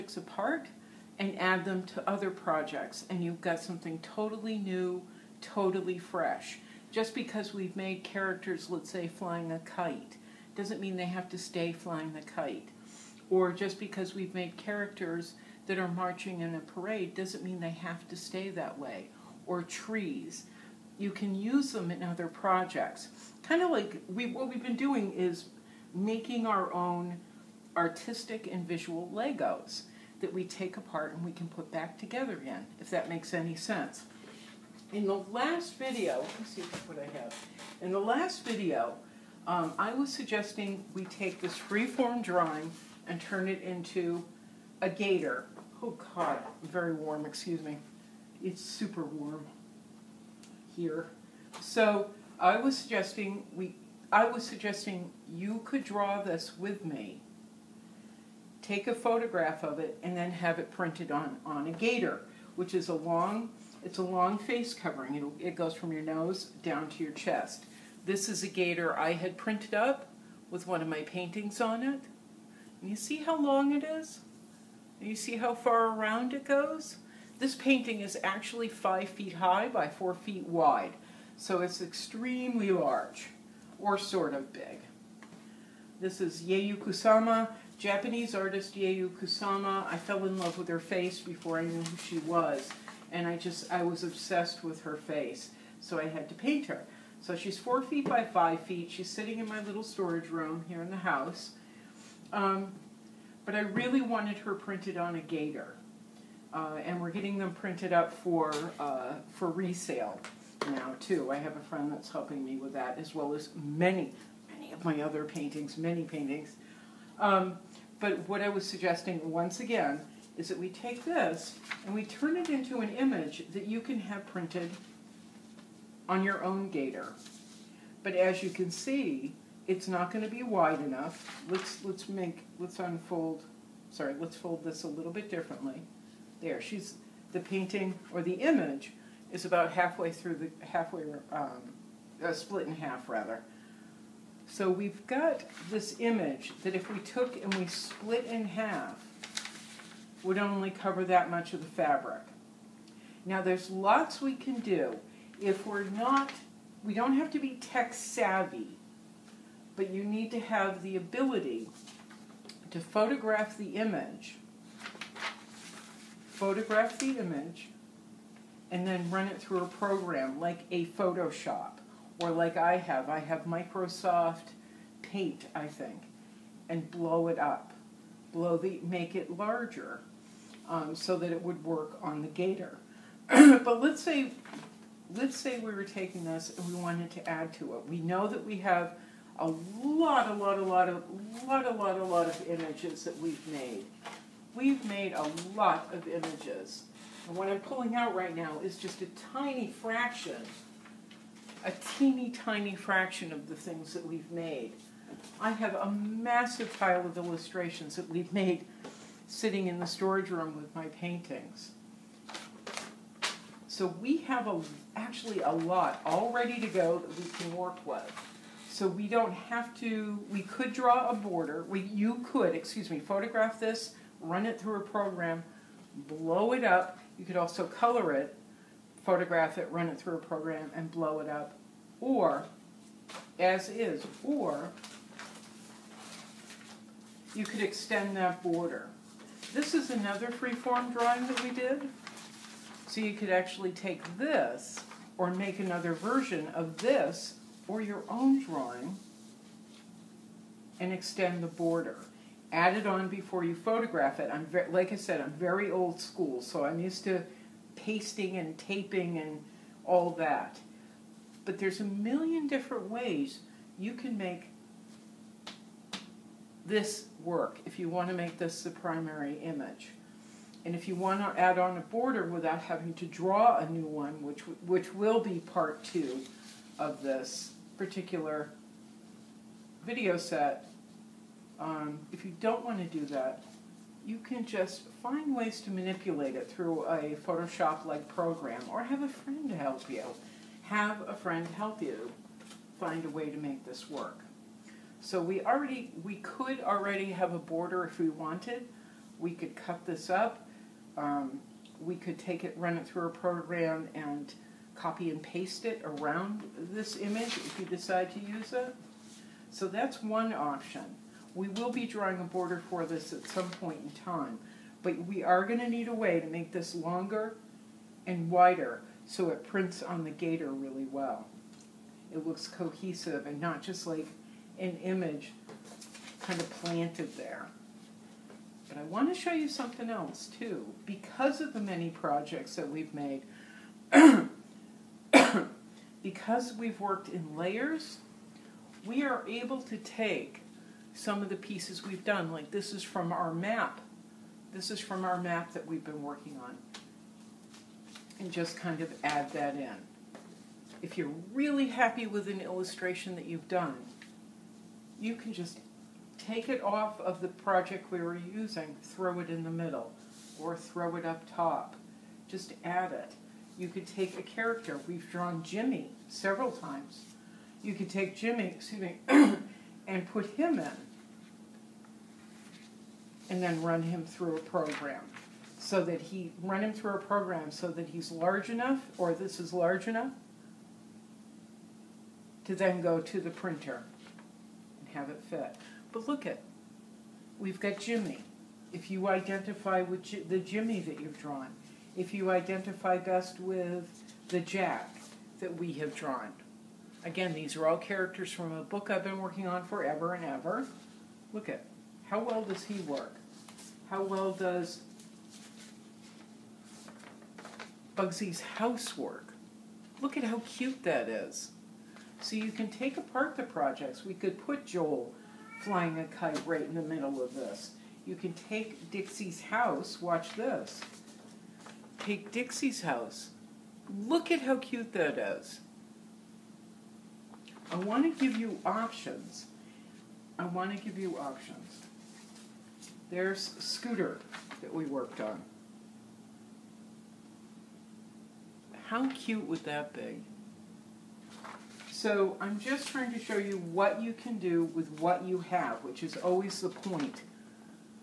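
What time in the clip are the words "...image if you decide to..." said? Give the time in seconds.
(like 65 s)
306 s.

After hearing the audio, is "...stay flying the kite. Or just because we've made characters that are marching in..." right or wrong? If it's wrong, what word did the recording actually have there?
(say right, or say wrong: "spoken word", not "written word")
right.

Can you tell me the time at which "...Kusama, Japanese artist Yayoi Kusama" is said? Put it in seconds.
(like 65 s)
86 s.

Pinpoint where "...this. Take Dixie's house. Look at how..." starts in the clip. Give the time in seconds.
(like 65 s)
420 s.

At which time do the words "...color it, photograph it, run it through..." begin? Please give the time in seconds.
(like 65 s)
227 s.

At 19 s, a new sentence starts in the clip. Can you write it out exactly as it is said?
Or trees you can use them in other projects.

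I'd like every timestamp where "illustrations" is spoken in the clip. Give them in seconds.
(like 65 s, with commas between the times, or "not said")
207 s, 352 s.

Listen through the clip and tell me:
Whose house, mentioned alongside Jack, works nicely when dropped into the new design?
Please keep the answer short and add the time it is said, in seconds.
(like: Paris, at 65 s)
Bugsy's, at 407 s.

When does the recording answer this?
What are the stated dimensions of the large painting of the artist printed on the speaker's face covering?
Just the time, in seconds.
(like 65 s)
78 s.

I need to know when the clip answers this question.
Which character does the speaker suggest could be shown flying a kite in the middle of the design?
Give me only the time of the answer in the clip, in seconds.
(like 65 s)
414 s.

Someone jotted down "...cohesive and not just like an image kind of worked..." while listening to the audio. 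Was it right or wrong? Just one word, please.
wrong.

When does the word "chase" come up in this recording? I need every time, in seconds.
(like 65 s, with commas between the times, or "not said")
not said.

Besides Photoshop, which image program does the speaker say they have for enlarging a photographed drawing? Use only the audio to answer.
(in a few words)
Microsoft Paint.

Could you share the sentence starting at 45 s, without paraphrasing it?
Oh God, very warm, excuse me.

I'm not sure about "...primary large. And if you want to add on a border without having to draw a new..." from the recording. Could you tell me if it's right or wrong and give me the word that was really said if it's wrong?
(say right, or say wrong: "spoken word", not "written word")
wrong: "image", not "large".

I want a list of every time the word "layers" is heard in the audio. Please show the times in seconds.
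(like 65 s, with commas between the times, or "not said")
337 s.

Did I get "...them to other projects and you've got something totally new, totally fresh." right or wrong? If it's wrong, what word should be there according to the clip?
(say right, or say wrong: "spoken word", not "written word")
right.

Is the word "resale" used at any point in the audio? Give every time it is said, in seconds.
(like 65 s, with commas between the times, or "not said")
109 s.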